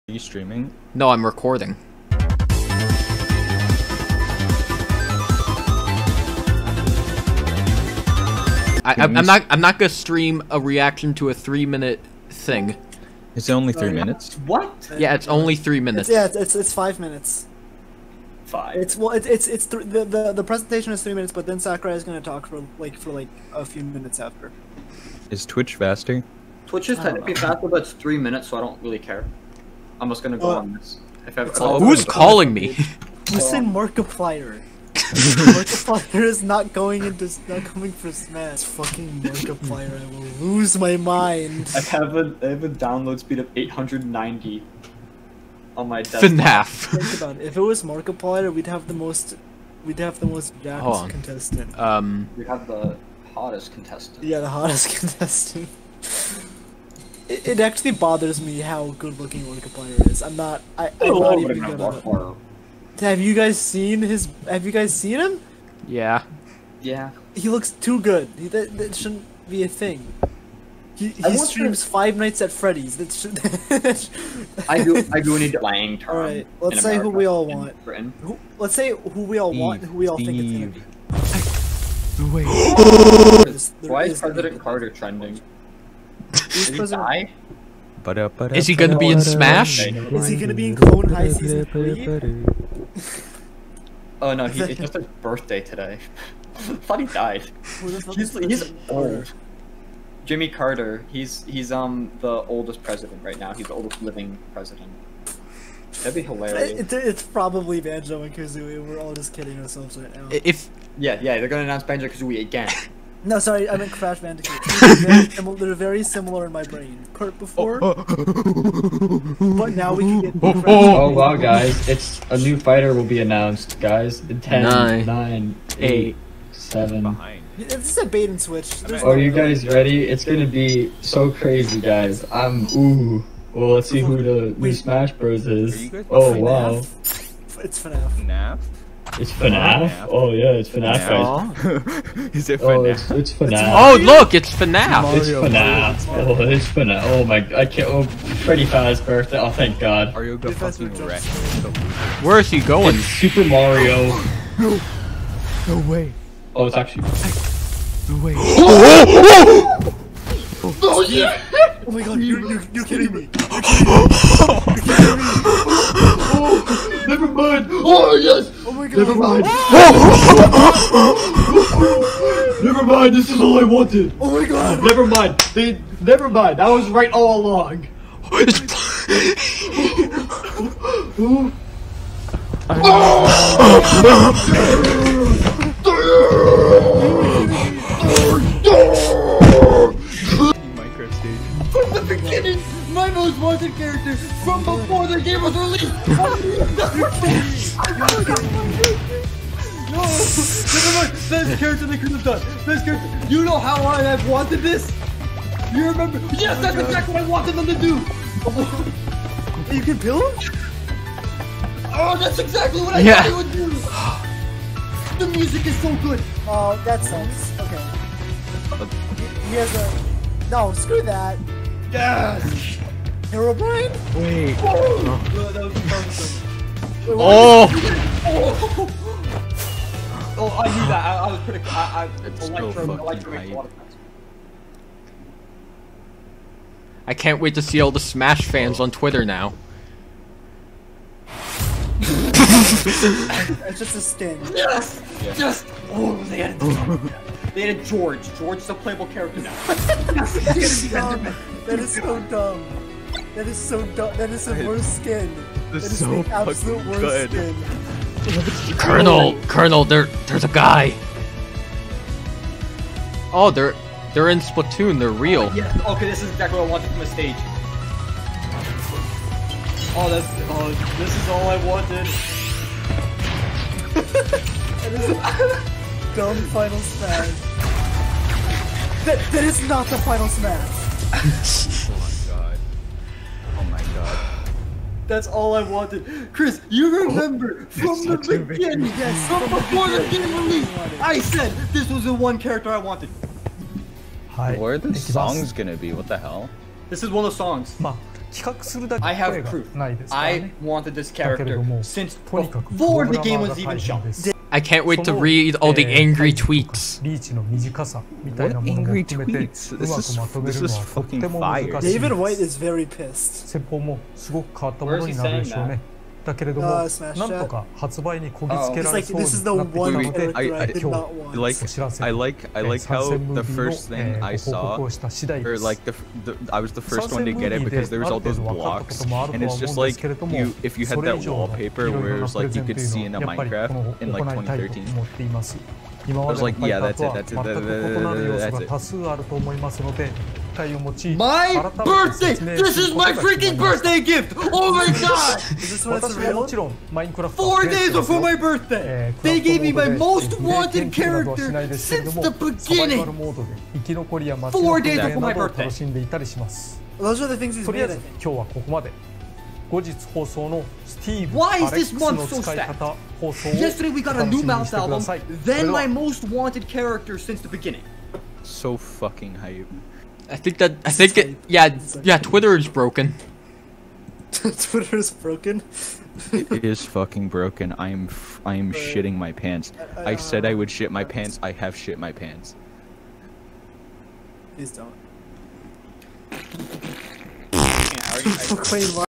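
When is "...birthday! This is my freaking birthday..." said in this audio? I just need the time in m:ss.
5:41.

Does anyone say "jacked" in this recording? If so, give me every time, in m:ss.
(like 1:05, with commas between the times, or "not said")
0:50.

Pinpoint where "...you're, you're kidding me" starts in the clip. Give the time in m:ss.
2:42.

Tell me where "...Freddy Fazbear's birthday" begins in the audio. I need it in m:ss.
2:28.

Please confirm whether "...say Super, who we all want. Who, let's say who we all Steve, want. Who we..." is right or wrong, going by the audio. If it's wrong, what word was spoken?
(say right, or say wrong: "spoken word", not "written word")
wrong: "America", not "Super".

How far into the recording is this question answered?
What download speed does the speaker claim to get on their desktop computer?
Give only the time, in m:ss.
0:43.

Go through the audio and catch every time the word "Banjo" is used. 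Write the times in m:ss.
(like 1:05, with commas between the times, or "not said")
1:47, 1:51.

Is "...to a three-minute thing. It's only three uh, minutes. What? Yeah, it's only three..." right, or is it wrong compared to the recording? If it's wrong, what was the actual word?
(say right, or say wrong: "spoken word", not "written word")
right.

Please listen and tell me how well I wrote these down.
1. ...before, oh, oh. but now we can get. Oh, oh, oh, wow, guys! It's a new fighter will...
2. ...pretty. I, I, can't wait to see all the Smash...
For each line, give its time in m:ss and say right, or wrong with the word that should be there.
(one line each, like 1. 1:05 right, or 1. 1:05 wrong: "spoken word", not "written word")
1. 1:57 right
2. 3:53 right.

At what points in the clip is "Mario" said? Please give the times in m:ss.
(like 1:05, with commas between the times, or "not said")
2:25, 2:33.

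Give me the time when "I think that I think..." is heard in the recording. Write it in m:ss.
6:10.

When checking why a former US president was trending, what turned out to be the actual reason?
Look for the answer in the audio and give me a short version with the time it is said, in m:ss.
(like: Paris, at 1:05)
his birthday, at 1:34.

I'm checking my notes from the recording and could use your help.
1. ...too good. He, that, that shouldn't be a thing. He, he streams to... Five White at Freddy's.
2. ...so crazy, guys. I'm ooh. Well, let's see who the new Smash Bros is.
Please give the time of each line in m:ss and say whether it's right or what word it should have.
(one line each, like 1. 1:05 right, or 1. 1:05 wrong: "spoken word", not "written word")
1. 1:07 wrong: "Nights", not "White"
2. 2:11 right.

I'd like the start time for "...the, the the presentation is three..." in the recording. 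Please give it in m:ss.
0:19.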